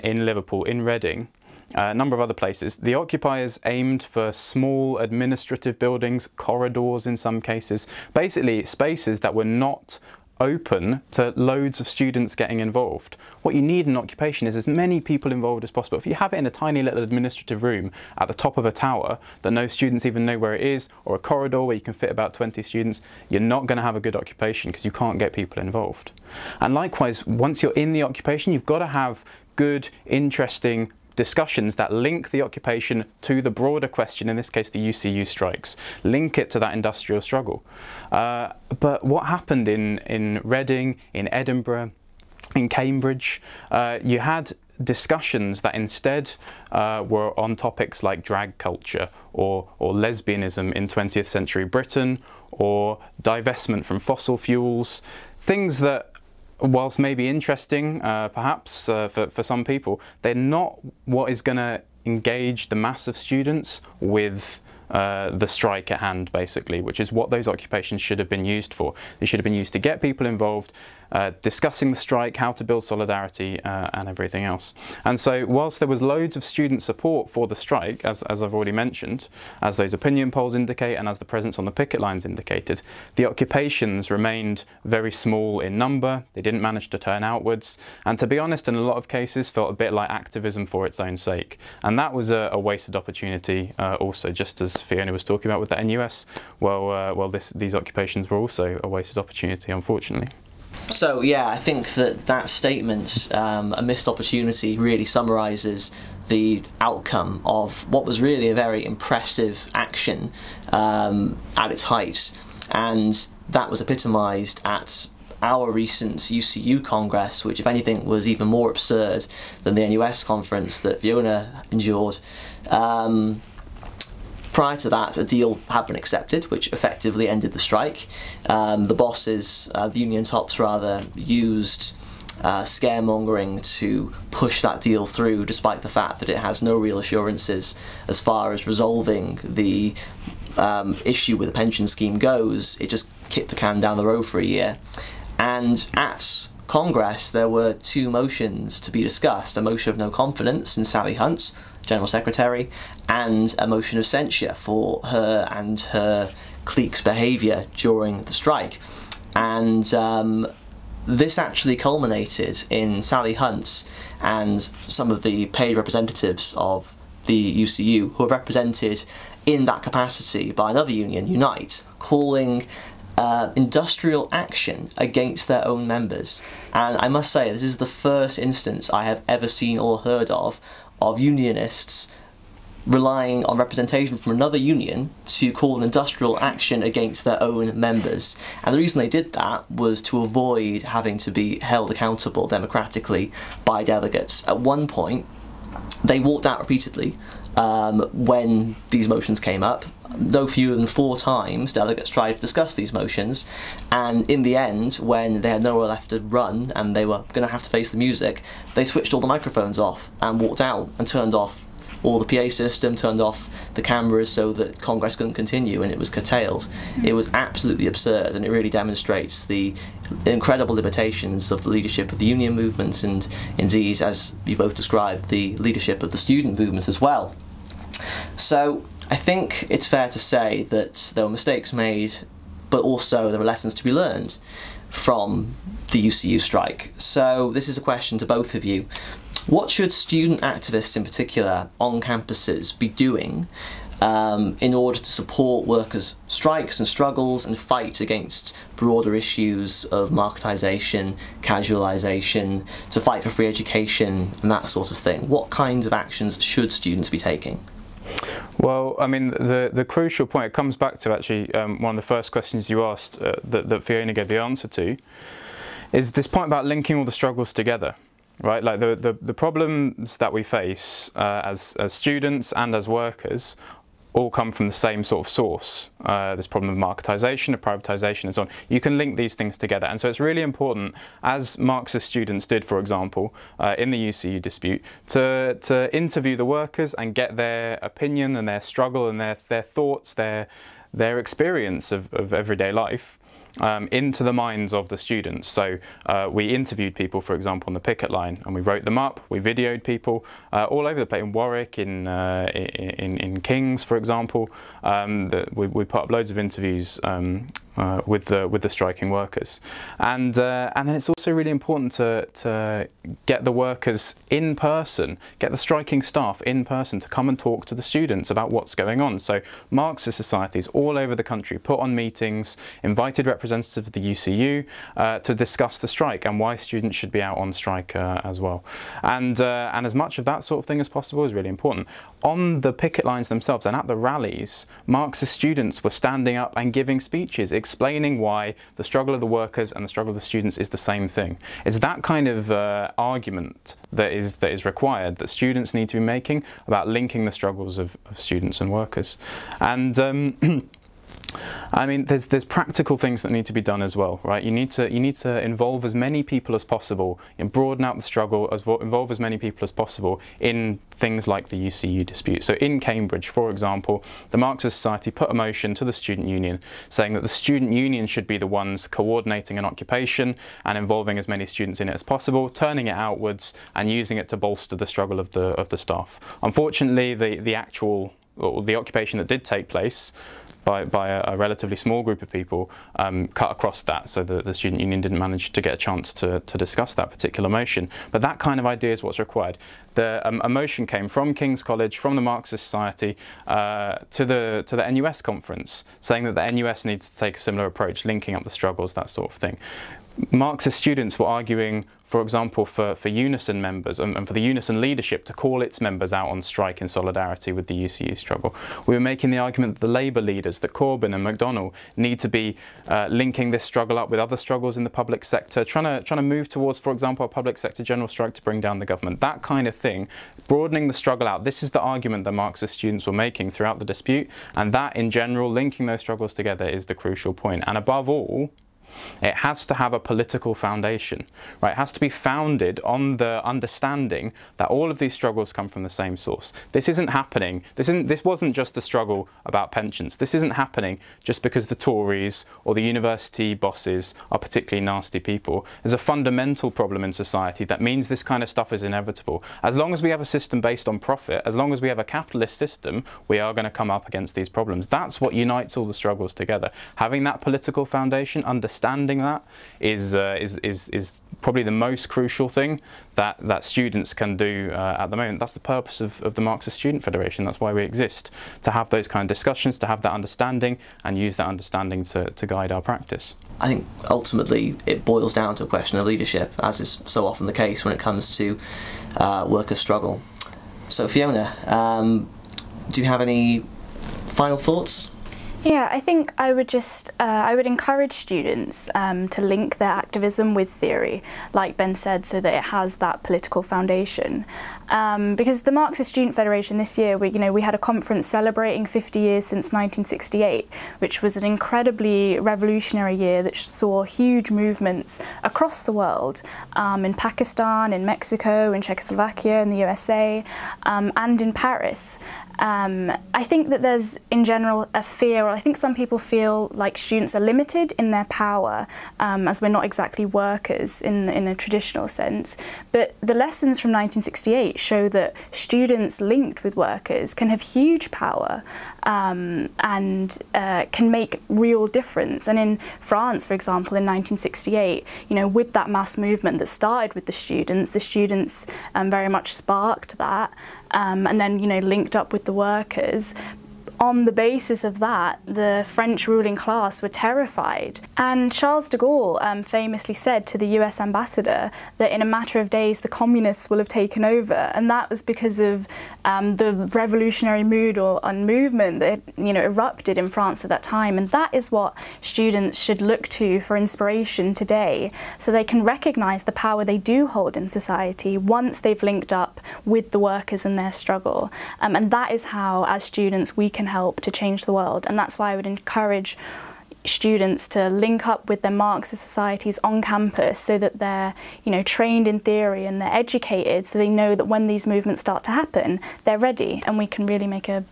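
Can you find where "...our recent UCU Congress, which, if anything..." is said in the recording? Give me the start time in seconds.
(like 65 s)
115 s.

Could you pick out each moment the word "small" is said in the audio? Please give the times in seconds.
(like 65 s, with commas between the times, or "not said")
4 s, 85 s, 381 s.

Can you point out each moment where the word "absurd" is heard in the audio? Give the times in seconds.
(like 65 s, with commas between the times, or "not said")
118 s, 217 s.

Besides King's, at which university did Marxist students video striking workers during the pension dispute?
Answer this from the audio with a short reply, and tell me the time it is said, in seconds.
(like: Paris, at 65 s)
Warwick, at 301 s.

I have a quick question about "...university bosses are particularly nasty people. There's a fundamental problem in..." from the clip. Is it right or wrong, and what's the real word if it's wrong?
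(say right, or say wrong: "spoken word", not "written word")
right.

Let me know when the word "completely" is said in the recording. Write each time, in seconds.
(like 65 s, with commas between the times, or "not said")
not said.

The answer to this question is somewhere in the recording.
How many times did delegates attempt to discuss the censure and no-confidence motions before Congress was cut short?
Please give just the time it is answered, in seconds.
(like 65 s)
200 s.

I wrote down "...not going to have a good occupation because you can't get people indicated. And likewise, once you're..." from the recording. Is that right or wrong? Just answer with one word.
wrong.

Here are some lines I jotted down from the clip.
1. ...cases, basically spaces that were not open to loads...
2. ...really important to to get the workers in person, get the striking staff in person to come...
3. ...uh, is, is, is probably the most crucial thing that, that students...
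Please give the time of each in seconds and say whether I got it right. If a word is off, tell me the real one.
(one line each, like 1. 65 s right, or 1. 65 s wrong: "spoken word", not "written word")
1. 7 s right
2. 311 s right
3. 460 s right.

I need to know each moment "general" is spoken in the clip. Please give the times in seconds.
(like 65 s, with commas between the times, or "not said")
151 s, 417 s, 425 s, 514 s.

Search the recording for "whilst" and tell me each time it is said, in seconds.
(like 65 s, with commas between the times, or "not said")
56 s, 75 s.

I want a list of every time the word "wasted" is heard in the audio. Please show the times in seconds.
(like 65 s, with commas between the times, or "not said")
92 s, 98 s.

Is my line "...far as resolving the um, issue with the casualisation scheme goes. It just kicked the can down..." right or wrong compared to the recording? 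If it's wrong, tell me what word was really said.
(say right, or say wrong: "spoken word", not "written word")
wrong: "pension", not "casualisation".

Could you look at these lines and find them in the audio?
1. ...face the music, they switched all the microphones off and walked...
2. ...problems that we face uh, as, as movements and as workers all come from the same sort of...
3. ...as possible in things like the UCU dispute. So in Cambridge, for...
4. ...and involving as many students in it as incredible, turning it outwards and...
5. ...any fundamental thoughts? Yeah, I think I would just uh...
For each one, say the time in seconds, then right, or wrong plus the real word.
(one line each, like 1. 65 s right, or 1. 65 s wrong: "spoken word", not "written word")
1. 207 s right
2. 269 s wrong: "students", not "movements"
3. 359 s right
4. 370 s wrong: "possible", not "incredible"
5. 483 s wrong: "final", not "fundamental".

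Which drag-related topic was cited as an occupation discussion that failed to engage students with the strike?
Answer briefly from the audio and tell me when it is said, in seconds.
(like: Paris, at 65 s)
drag culture, at 48 s.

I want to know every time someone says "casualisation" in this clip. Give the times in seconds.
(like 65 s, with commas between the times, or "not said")
251 s.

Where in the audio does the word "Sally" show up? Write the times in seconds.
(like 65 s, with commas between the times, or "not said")
150 s, 163 s.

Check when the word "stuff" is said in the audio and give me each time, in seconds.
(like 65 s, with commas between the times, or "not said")
448 s.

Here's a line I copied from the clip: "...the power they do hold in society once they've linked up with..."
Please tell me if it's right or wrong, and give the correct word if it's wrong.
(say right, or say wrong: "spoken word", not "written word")
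right.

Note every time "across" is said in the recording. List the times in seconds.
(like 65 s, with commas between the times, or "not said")
383 s, 505 s.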